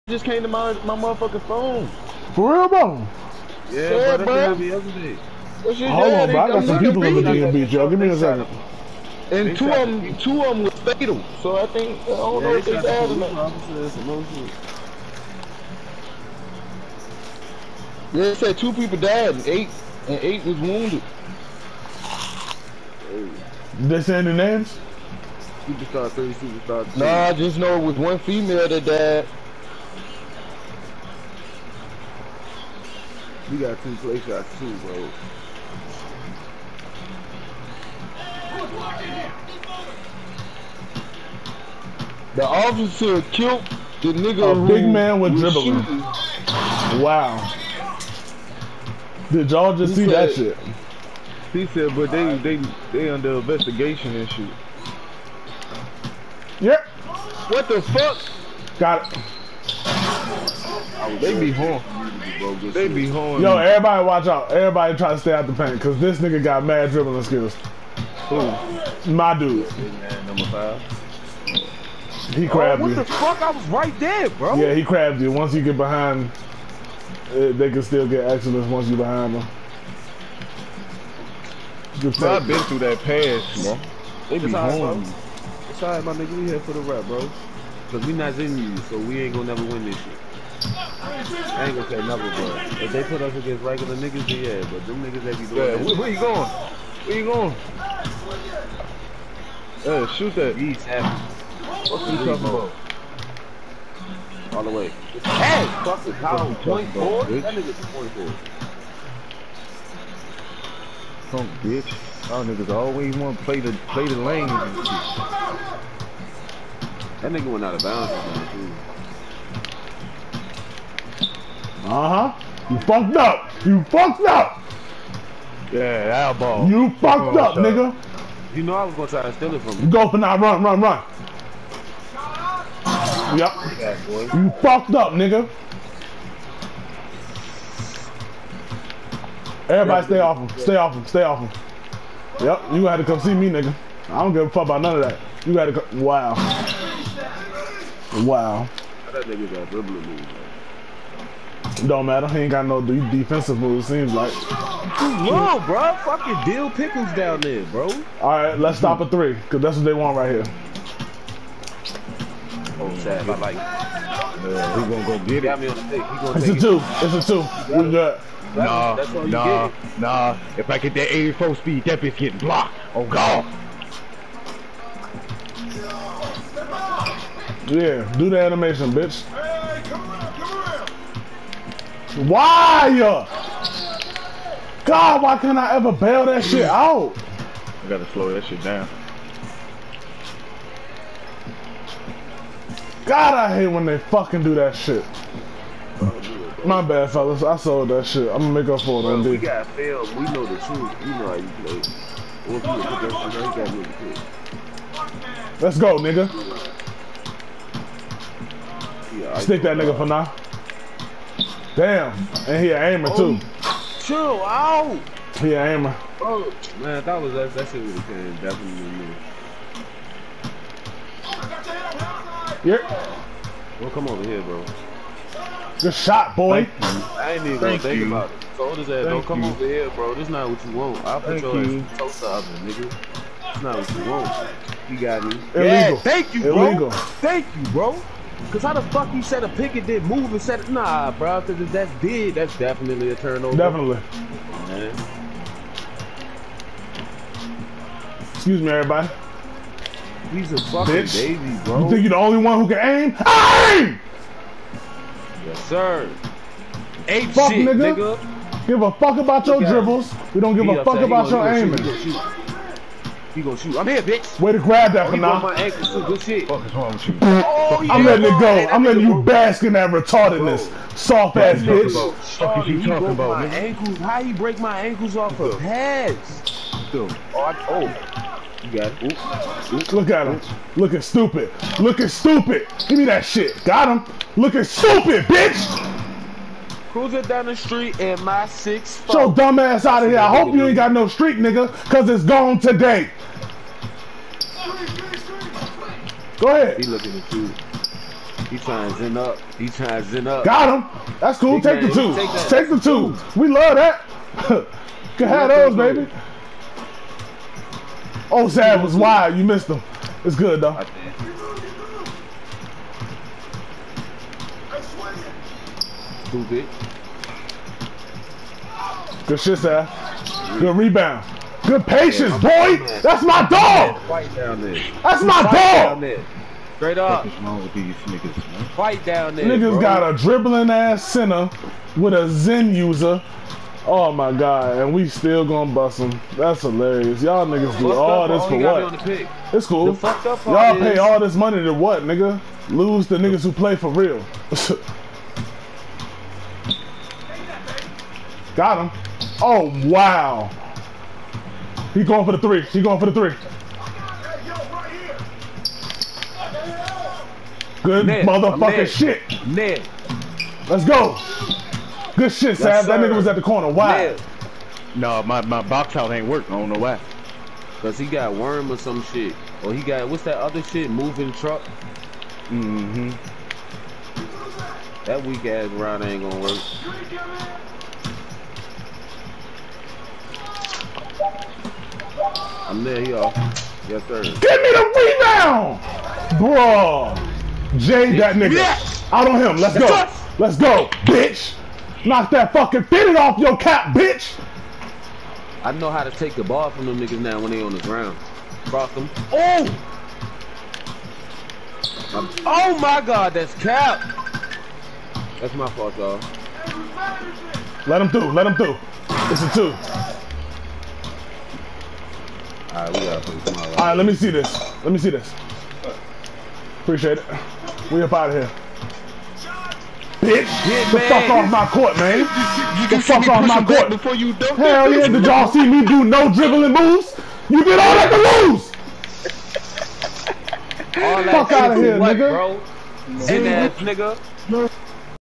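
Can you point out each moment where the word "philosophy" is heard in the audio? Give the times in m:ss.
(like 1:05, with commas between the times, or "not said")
not said.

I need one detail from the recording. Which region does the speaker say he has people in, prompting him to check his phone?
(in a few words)
DMV.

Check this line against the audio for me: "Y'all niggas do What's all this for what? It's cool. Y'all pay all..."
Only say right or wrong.
right.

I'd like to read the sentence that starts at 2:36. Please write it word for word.
Fucking deal pickles down there, bro.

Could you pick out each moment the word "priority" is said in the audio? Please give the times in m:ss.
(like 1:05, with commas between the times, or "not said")
not said.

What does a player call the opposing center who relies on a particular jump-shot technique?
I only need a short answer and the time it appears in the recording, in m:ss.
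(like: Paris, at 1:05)
a Zen user, at 5:32.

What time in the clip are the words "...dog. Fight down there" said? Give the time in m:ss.
5:23.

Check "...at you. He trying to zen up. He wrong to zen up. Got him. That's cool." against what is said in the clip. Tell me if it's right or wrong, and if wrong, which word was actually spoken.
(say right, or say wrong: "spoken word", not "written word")
wrong: "trying", not "wrong".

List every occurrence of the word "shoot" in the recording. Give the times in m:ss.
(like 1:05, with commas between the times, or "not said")
1:40, 4:23.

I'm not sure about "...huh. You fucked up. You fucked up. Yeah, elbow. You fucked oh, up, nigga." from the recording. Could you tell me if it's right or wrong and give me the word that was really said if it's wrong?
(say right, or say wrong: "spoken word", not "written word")
right.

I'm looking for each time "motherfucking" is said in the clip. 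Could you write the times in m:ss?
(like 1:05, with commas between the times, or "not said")
0:00, 5:58.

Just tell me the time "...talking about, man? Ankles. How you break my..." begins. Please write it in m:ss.
4:32.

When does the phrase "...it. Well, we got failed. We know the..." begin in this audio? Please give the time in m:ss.
3:19.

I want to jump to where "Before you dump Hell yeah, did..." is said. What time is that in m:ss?
7:03.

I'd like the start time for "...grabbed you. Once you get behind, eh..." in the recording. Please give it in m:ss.
1:14.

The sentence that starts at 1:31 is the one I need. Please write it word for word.
I ain't gonna say nothing, bro.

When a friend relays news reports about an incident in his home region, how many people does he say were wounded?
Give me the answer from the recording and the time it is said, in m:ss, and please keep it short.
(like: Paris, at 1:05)
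8, at 0:20.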